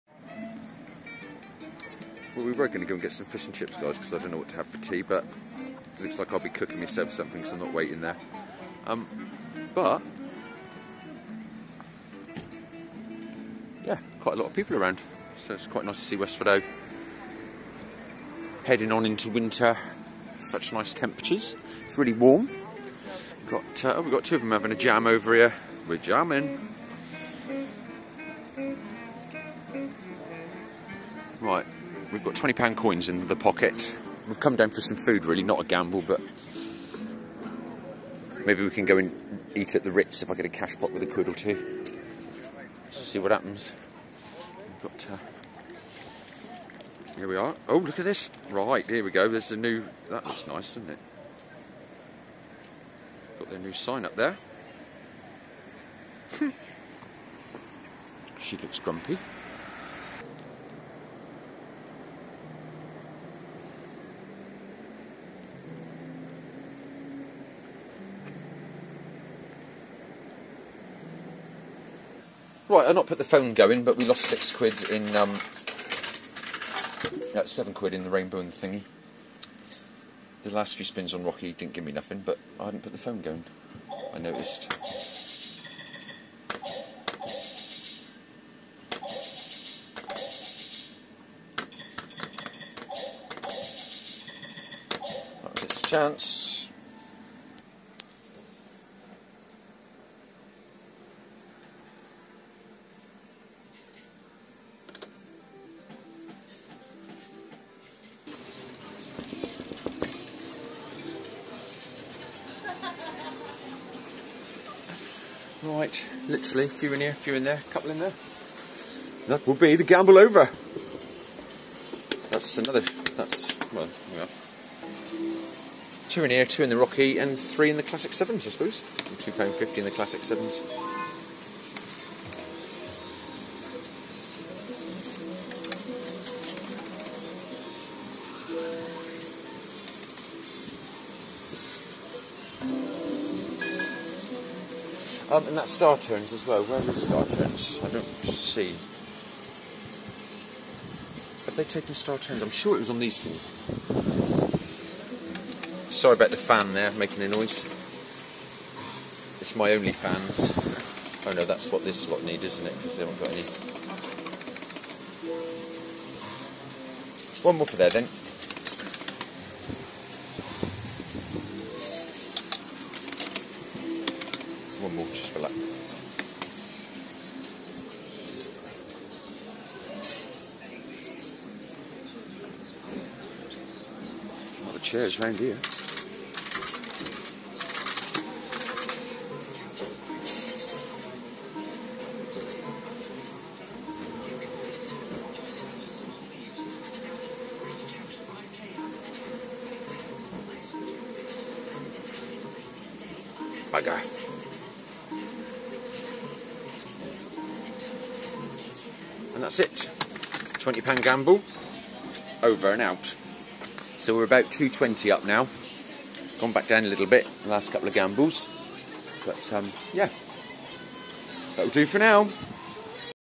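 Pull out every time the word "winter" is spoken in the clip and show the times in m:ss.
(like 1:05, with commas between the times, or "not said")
0:19.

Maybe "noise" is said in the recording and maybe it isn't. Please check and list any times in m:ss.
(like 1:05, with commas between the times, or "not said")
2:37.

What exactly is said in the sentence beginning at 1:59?
That will be the gamble over.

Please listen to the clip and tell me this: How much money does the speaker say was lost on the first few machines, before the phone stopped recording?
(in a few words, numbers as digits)
£6.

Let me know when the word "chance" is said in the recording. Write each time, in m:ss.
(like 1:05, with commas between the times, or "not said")
1:35.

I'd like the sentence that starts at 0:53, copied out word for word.
Got their new sign up there.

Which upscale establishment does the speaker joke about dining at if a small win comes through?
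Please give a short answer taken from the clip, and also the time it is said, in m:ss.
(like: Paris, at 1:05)
the Ritz, at 0:39.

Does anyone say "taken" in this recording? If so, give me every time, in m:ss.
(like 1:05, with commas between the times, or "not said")
2:31.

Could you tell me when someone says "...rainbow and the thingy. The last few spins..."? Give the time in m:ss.
1:18.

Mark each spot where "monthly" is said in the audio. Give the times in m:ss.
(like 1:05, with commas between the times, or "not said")
not said.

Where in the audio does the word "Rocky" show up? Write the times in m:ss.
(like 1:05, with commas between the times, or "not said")
1:21, 2:06.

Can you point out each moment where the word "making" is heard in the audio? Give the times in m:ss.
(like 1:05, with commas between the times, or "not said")
2:36.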